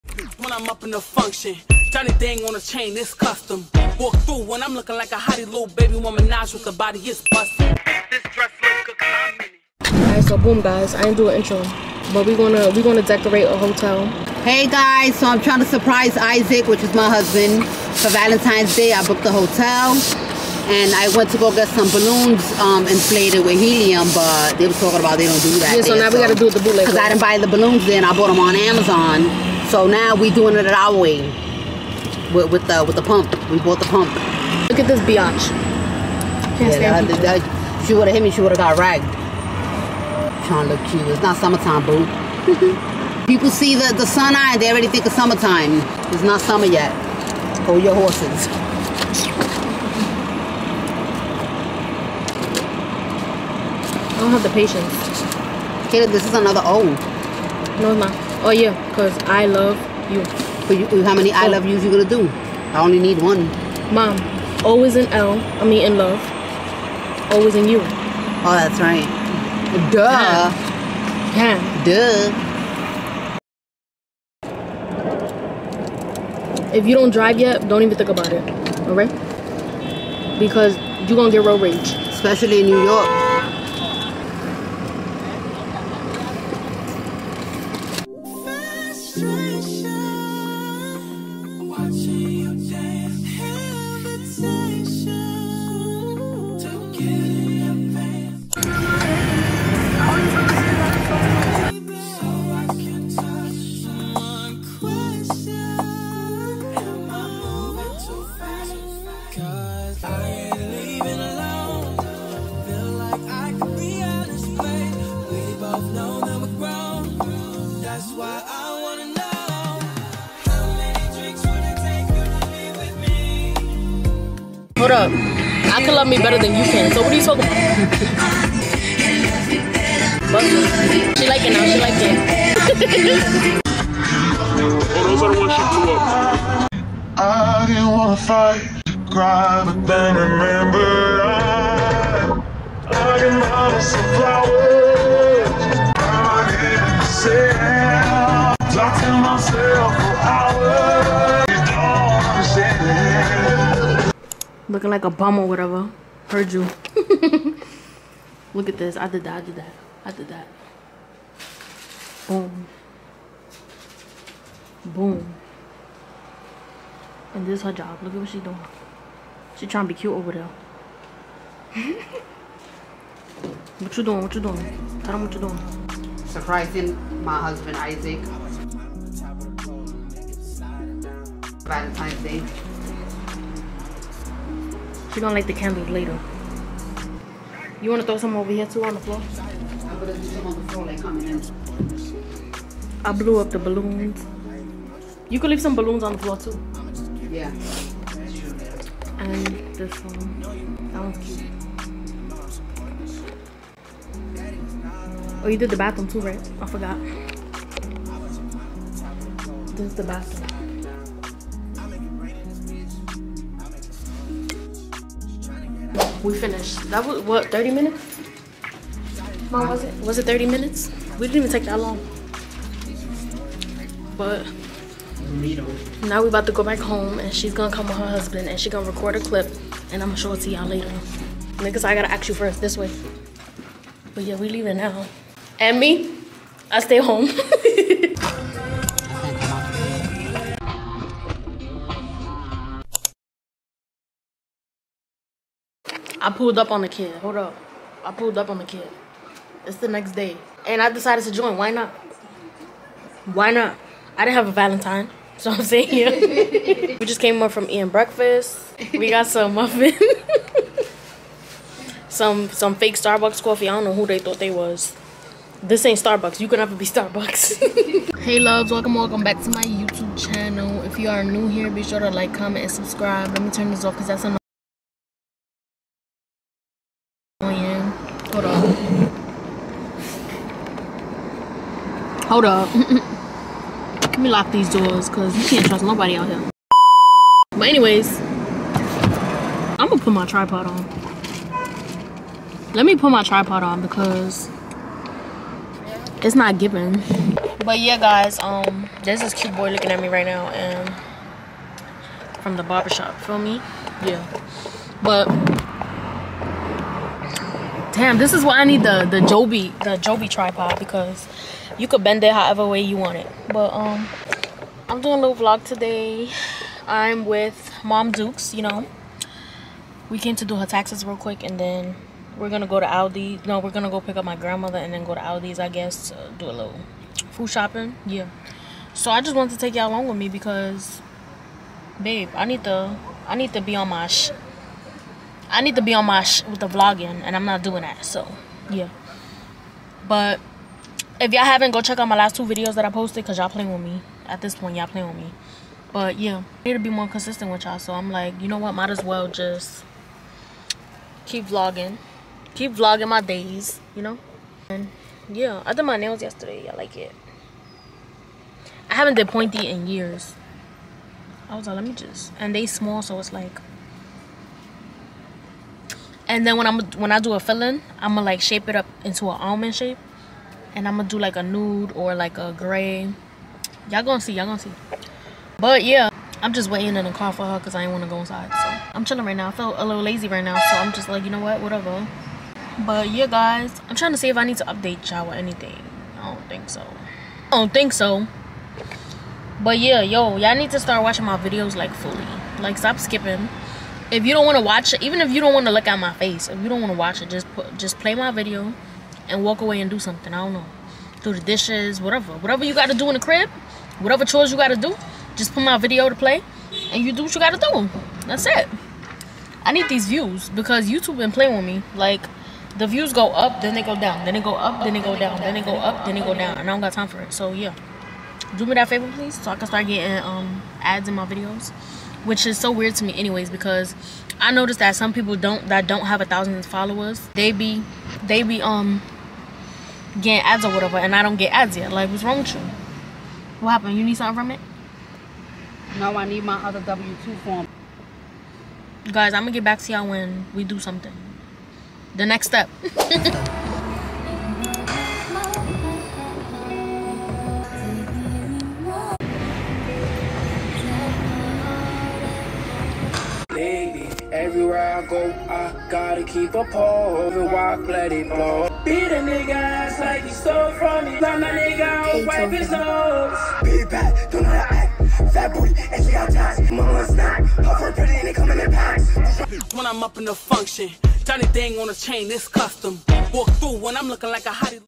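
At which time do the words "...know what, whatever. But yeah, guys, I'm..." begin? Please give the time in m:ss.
6:21.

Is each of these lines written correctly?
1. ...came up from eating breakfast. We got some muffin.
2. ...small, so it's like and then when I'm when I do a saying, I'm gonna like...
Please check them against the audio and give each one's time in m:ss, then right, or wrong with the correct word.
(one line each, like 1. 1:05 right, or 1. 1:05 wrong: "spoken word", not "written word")
1. 4:17 right
2. 6:02 wrong: "filling", not "saying".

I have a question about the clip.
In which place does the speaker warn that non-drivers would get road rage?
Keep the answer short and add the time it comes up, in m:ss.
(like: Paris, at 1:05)
New York, at 1:22.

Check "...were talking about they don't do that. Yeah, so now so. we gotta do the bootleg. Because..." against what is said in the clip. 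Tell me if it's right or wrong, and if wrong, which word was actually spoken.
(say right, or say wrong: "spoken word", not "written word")
right.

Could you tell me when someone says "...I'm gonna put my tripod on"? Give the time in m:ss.
4:49.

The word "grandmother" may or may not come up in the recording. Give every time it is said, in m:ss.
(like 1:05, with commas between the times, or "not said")
5:24.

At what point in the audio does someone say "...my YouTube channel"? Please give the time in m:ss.
4:29.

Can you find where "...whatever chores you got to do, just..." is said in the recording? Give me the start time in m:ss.
6:43.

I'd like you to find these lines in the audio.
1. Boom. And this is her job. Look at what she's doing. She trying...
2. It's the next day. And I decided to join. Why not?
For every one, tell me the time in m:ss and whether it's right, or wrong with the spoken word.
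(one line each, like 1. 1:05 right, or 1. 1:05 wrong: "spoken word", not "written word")
1. 2:44 right
2. 4:09 right.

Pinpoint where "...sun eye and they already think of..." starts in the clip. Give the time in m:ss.
0:44.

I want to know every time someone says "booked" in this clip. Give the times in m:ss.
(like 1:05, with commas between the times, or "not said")
0:19.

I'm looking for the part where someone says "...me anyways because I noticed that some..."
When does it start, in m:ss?
7:03.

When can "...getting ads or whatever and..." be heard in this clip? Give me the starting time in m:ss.
7:10.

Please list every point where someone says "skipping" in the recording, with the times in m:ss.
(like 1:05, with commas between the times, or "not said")
6:32.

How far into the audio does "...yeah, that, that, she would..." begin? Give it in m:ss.
0:36.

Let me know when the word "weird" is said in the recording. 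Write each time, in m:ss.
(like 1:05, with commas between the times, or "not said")
7:02.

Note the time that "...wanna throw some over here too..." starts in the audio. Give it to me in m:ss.
3:07.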